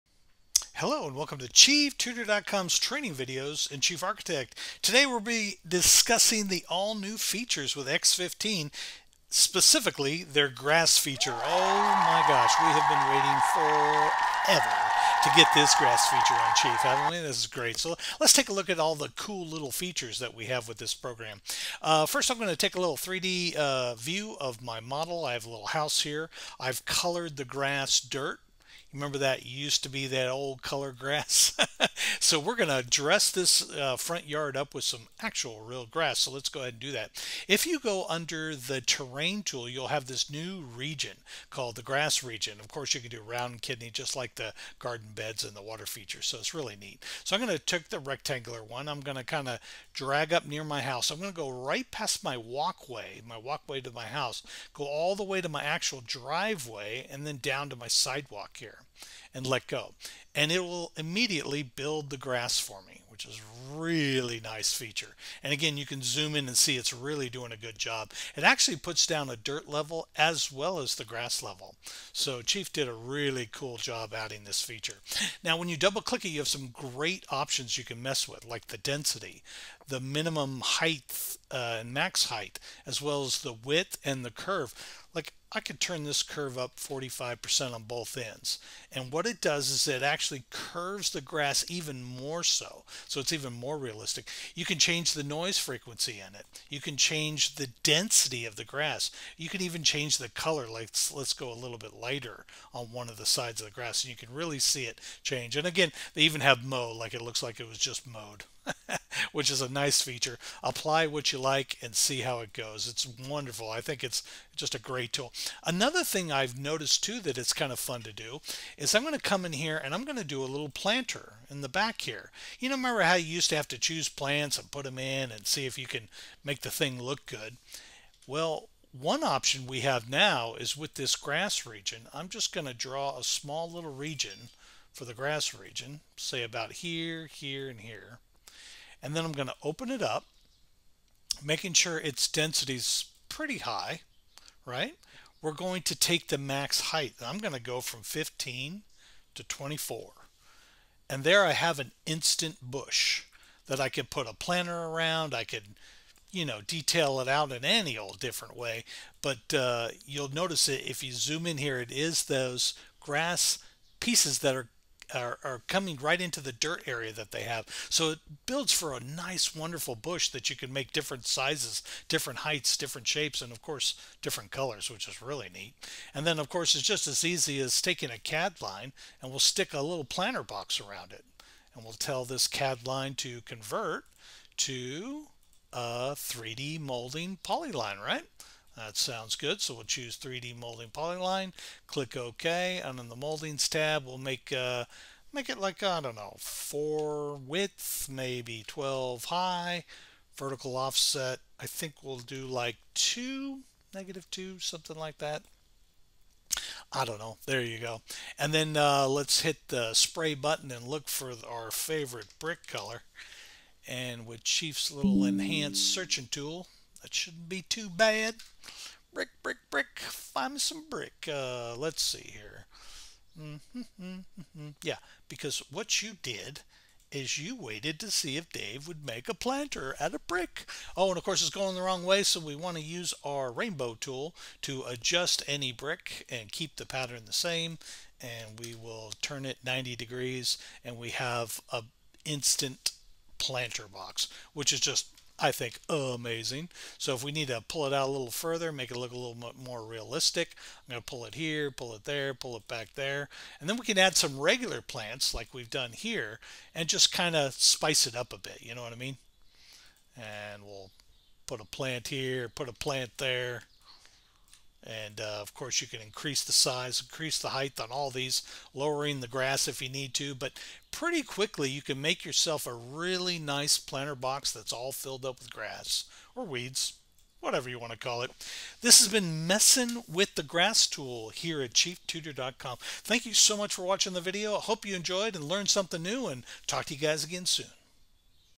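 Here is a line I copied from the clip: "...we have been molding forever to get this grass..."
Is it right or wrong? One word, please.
wrong.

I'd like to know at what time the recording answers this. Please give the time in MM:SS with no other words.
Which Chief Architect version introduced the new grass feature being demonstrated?
00:07.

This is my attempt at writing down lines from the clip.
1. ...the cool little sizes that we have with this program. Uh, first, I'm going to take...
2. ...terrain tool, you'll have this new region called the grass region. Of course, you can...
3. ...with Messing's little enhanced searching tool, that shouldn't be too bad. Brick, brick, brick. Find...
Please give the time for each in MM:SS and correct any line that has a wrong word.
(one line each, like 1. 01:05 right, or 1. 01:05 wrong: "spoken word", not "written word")
1. 00:18 wrong: "features", not "sizes"
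2. 00:38 right
3. 03:34 wrong: "Chief", not "Messing".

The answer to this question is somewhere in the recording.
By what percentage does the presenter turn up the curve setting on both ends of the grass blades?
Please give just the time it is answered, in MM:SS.
01:26.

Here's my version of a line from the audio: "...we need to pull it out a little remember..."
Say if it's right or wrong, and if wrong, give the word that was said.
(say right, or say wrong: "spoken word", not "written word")
wrong: "further", not "remember".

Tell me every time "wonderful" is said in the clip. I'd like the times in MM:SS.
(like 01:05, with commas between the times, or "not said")
01:53, 02:49.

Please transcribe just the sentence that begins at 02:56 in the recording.
And then, of course, it's just as easy as taking a CAD line and we'll stick a little planter box around it.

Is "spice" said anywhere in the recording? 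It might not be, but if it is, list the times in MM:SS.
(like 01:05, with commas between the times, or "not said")
04:17.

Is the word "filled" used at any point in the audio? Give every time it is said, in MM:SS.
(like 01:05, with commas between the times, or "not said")
04:34.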